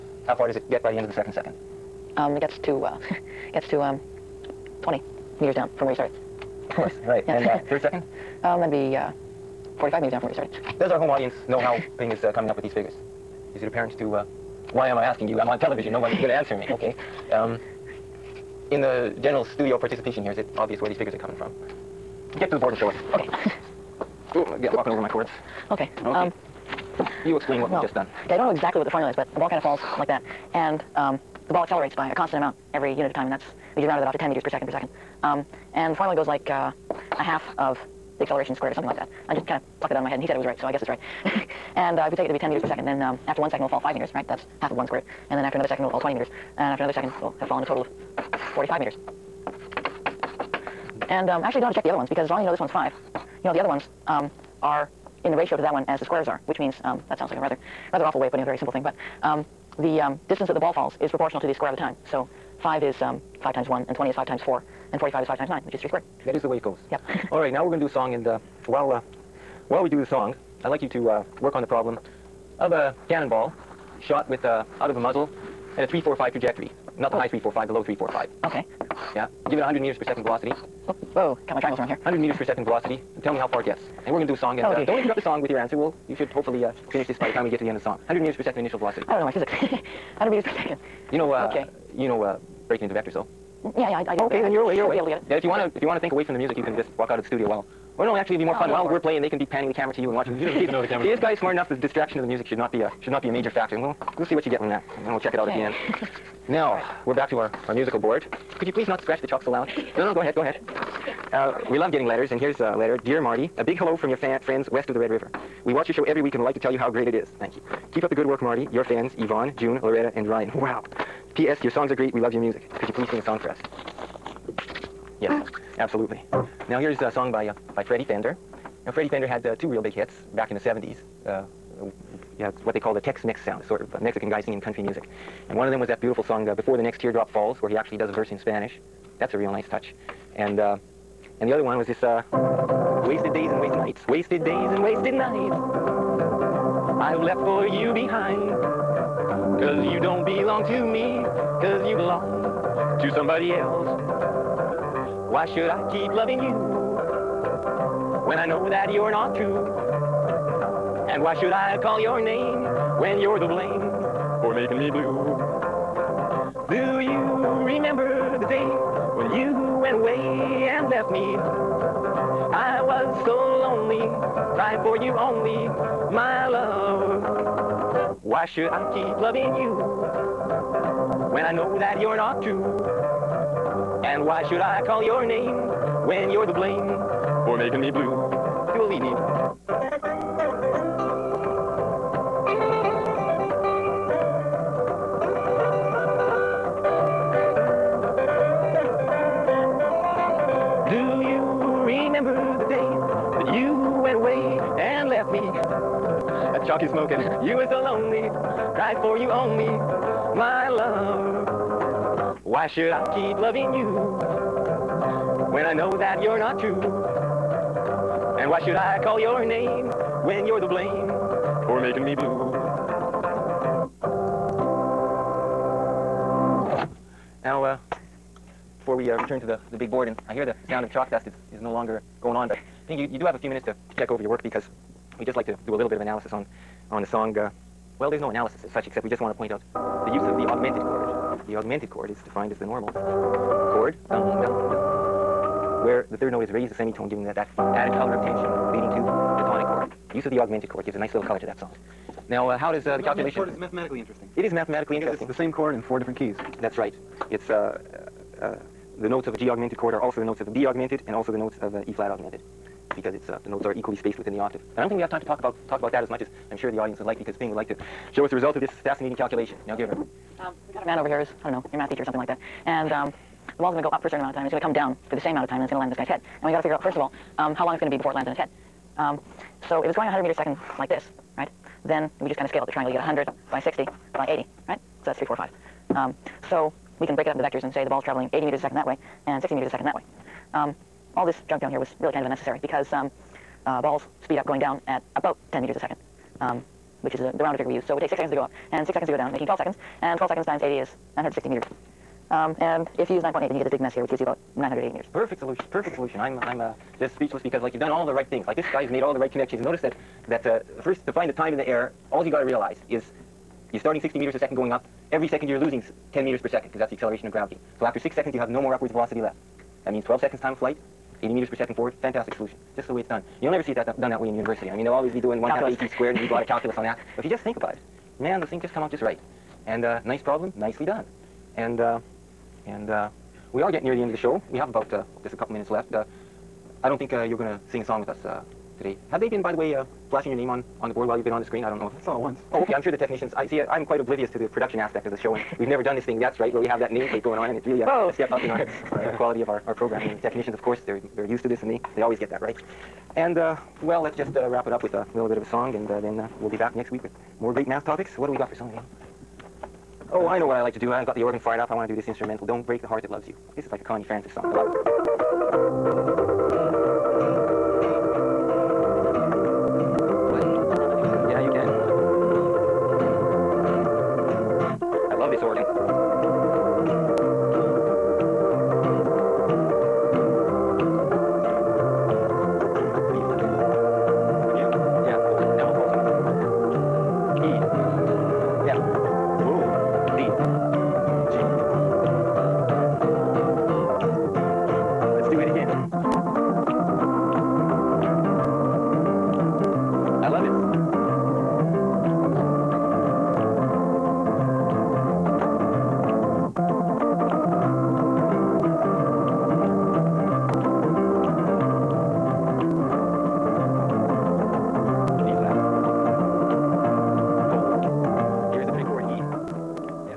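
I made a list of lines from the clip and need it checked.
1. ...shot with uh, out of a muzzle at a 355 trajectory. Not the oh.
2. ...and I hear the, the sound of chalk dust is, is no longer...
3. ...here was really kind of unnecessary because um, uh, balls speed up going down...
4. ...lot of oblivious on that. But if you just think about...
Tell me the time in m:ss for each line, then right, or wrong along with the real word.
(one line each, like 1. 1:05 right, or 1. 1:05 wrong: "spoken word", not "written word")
1. 1:14 wrong: "345", not "355"
2. 3:50 right
3. 4:51 right
4. 5:26 wrong: "calculus", not "oblivious".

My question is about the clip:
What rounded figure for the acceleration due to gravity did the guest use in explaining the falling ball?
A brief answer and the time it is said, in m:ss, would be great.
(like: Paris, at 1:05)
10 meters per second per second, at 0:34.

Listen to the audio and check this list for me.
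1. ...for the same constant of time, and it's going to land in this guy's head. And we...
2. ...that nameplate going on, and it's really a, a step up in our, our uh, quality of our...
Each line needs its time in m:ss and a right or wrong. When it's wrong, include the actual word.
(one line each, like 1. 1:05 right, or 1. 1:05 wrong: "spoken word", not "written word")
1. 4:35 wrong: "amount", not "constant"
2. 5:46 right.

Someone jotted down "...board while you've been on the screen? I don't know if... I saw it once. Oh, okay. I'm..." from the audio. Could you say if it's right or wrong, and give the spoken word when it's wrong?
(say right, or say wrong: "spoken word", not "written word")
right.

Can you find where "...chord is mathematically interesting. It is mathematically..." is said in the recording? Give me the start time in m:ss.
4:13.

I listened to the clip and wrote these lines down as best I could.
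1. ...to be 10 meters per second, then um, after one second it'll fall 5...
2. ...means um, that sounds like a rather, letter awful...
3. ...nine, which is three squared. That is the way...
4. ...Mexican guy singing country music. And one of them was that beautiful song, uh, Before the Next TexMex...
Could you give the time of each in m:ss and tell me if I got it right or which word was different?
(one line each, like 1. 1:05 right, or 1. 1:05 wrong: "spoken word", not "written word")
1. 0:42 right
2. 0:56 wrong: "rather", not "letter"
3. 1:05 right
4. 2:13 wrong: "Teardrop", not "TexMex".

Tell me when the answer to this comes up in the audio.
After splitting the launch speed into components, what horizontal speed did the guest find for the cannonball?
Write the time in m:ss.
4:48.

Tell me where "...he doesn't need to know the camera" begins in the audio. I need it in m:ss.
1:40.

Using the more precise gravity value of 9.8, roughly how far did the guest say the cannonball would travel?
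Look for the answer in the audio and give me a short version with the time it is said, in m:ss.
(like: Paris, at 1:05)
980 meters, at 5:04.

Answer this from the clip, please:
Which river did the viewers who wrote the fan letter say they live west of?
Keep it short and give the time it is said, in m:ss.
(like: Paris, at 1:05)
Red River, at 1:54.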